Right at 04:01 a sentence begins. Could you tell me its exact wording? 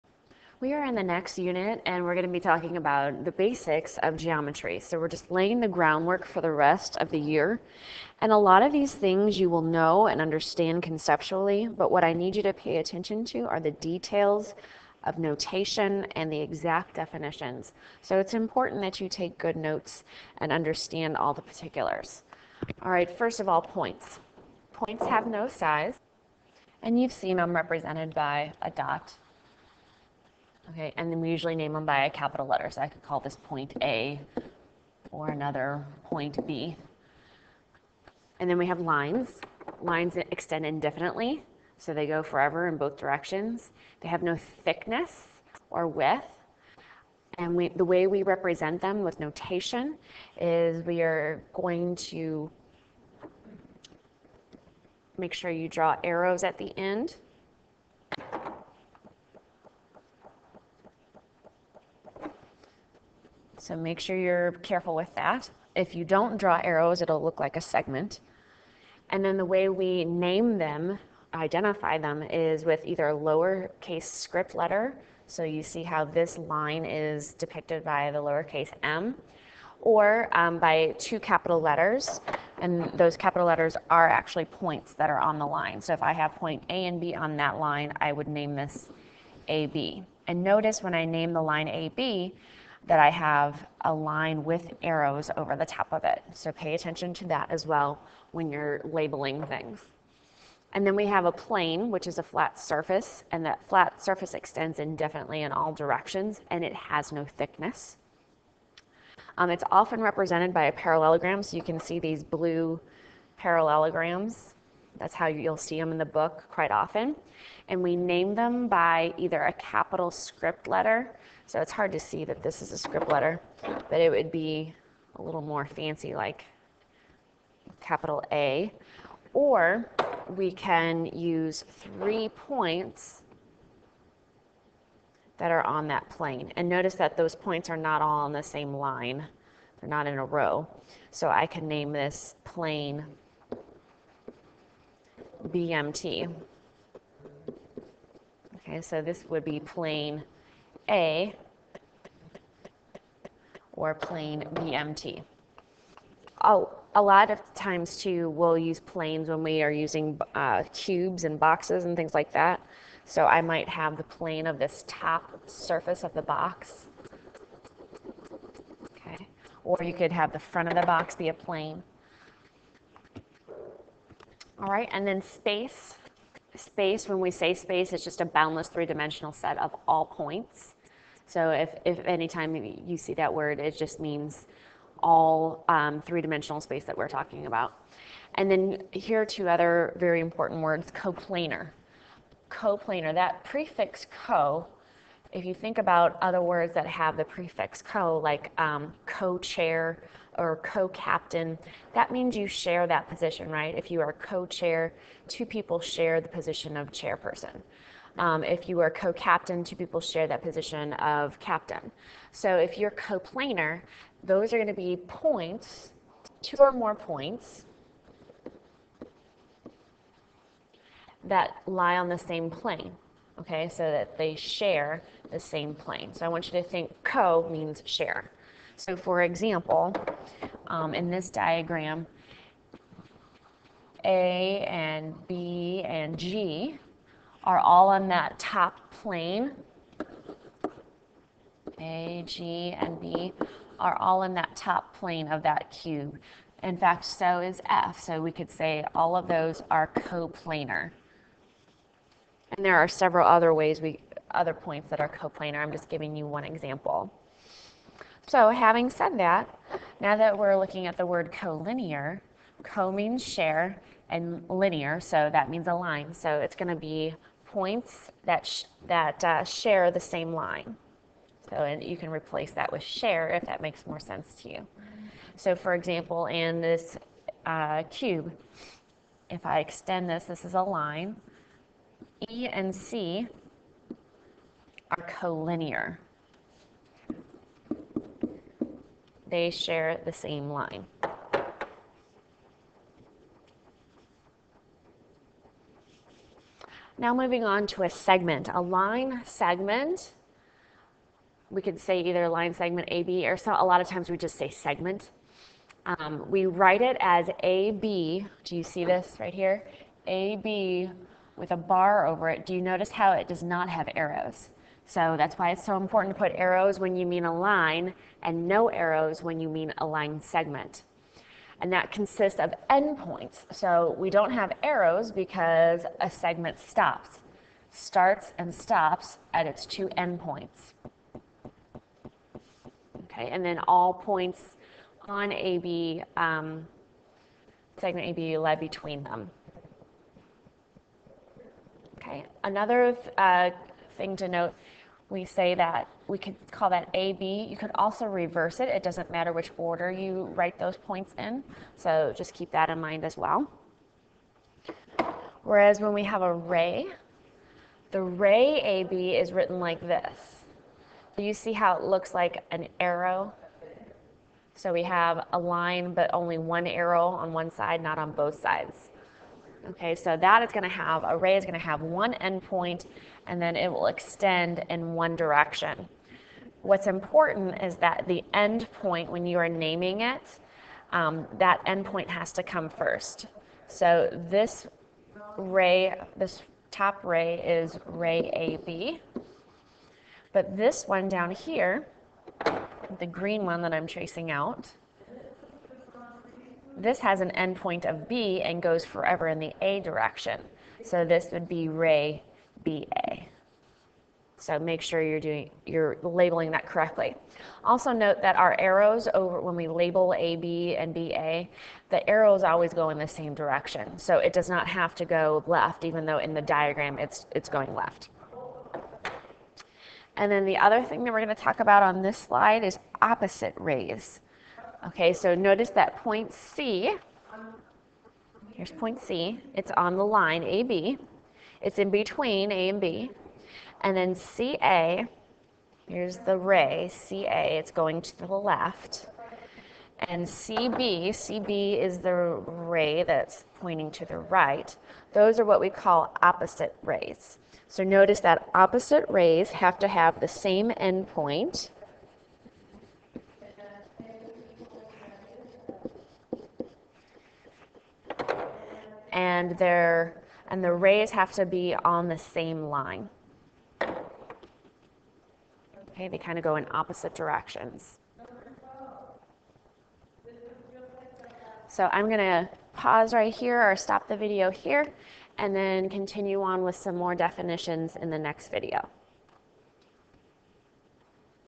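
A, G, and B are all in that top plane of that cube.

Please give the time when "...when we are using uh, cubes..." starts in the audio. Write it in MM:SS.
02:39.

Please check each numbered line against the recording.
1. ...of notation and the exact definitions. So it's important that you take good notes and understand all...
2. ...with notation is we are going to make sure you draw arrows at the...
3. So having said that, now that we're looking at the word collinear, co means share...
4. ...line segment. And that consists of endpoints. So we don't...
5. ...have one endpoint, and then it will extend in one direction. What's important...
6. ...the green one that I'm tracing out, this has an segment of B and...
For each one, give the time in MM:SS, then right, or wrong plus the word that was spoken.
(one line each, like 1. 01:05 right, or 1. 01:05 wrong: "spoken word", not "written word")
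1. 00:15 right
2. 00:49 right
3. 04:18 right
4. 05:19 right
5. 06:11 right
6. 06:32 wrong: "endpoint", not "segment".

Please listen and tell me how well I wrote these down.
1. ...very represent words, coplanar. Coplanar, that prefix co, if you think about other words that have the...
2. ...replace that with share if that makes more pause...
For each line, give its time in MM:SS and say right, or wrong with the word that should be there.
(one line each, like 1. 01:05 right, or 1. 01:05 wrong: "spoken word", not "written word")
1. 03:09 wrong: "important", not "represent"
2. 04:32 wrong: "sense", not "pause".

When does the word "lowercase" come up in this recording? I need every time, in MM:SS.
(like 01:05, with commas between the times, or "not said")
01:13, 01:18.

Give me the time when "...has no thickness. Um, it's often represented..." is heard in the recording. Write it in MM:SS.
01:46.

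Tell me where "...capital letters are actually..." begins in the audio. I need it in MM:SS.
01:23.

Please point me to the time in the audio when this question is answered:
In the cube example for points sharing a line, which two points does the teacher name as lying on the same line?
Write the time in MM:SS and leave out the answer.
04:42.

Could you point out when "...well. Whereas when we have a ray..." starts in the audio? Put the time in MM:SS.
05:53.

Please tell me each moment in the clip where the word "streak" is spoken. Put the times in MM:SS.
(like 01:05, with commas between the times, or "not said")
not said.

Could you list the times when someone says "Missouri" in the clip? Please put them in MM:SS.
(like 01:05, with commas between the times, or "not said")
not said.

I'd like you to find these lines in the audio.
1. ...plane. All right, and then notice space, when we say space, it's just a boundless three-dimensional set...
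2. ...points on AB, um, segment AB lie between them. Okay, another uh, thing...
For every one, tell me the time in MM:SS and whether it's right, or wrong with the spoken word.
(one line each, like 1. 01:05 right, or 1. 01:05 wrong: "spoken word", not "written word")
1. 02:51 wrong: "space", not "notice"
2. 05:33 right.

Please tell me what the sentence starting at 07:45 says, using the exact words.
Okay, they kind of go in opposite directions.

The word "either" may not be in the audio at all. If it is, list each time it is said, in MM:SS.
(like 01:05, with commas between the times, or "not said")
01:12, 01:59, 05:02.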